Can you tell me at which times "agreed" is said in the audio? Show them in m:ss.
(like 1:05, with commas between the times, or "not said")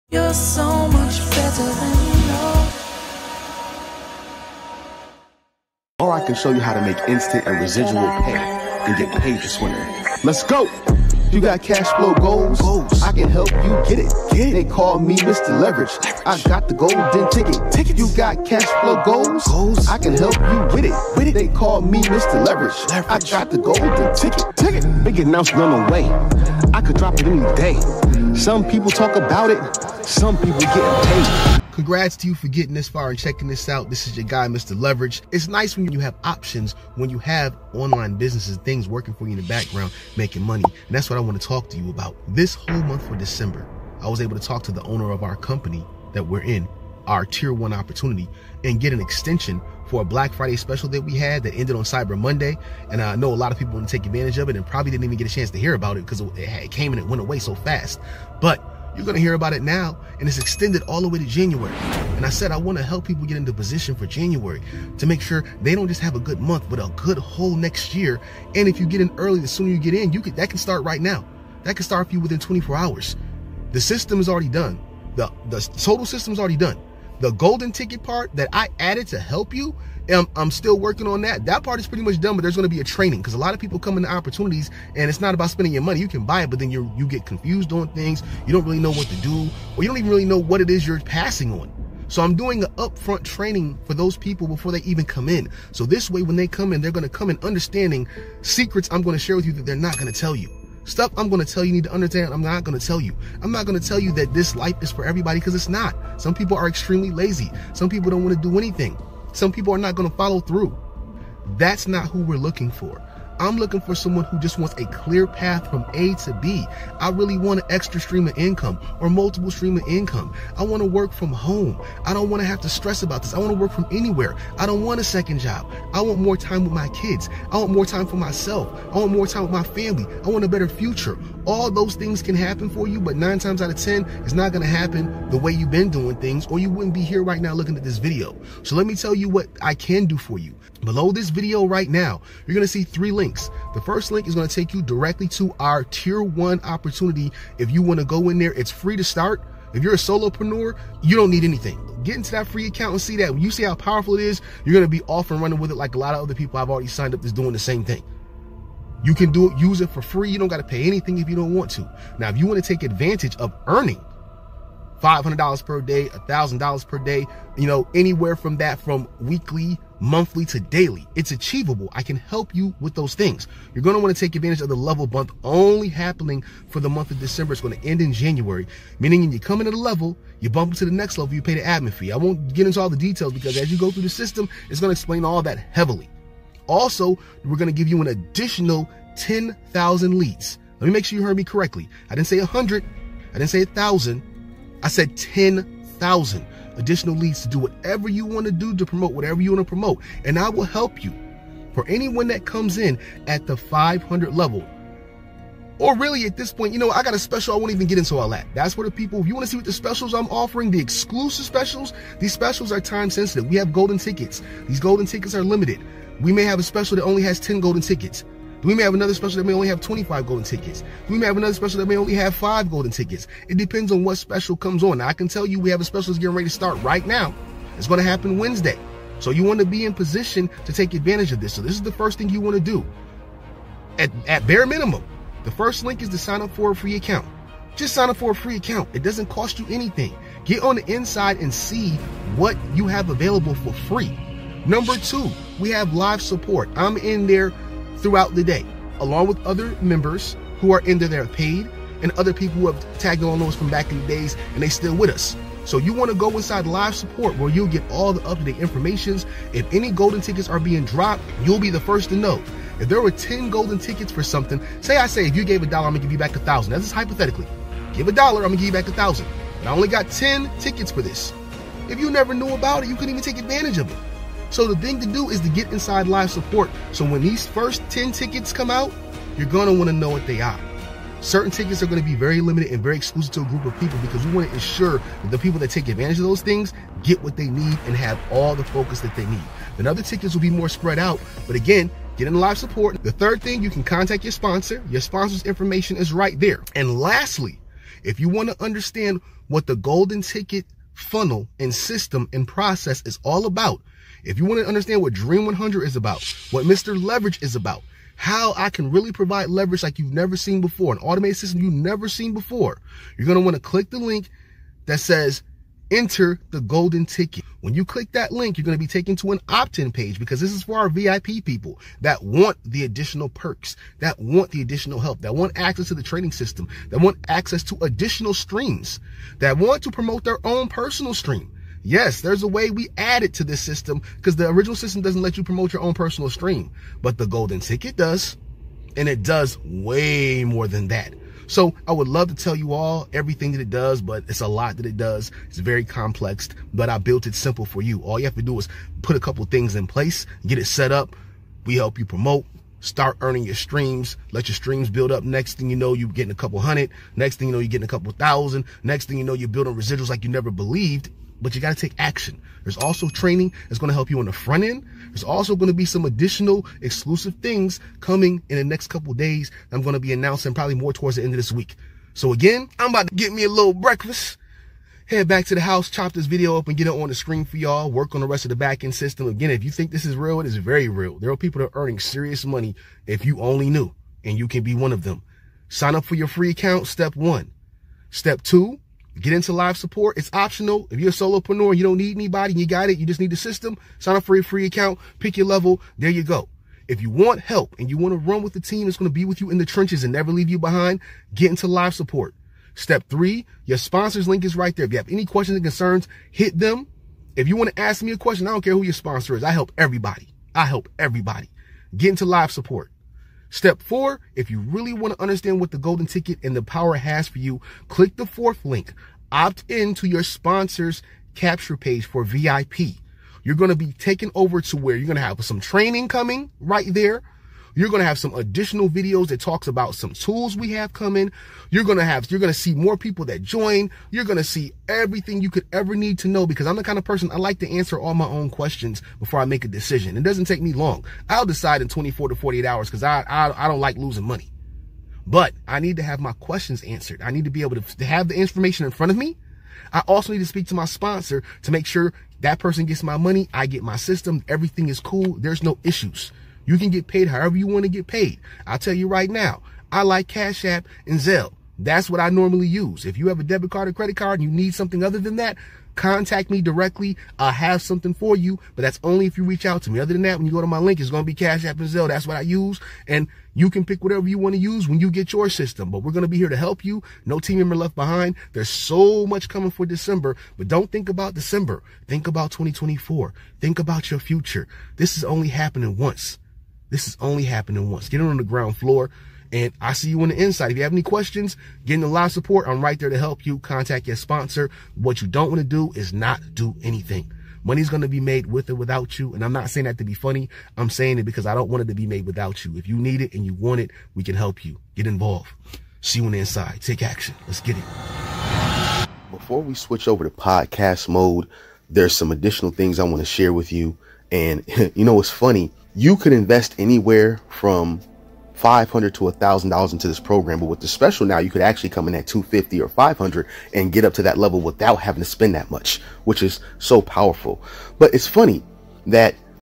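not said.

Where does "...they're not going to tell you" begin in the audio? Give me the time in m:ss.
1:39.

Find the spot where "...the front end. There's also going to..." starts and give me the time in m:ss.
6:04.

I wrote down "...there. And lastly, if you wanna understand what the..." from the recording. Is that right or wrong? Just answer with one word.
right.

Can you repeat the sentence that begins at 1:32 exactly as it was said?
So I'm doing an upfront training for those people before they even come in.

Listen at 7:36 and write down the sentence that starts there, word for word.
You can get paid however you want to get paid.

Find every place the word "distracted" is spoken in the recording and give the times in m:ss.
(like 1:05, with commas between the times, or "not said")
not said.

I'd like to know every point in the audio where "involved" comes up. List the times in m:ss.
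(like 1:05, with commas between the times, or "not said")
8:25.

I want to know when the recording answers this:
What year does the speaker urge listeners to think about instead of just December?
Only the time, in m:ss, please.
8:02.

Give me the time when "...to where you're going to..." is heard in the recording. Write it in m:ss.
7:04.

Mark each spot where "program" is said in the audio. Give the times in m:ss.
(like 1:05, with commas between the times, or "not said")
8:40.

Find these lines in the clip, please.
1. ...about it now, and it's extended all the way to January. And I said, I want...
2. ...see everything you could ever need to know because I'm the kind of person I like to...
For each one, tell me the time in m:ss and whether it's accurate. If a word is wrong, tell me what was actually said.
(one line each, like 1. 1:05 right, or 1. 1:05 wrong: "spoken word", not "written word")
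1. 0:59 right
2. 7:14 right.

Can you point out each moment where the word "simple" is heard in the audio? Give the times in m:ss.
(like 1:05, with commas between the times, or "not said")
5:47.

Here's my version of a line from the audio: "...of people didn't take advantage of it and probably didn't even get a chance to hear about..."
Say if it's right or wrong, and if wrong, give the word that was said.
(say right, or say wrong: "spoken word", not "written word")
right.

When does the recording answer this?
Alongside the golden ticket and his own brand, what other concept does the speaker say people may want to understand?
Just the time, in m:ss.
5:05.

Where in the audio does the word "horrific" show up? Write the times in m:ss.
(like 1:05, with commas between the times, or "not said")
not said.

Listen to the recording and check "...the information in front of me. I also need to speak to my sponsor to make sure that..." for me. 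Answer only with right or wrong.
right.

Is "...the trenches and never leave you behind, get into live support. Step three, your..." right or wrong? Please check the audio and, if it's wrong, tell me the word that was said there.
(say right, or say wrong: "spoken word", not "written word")
right.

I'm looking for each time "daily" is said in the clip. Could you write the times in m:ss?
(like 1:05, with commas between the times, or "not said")
2:50.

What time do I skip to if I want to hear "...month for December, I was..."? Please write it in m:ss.
0:42.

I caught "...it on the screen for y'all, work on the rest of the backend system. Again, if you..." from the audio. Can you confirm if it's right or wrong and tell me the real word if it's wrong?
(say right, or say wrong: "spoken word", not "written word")
right.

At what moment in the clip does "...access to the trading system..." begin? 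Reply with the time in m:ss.
5:25.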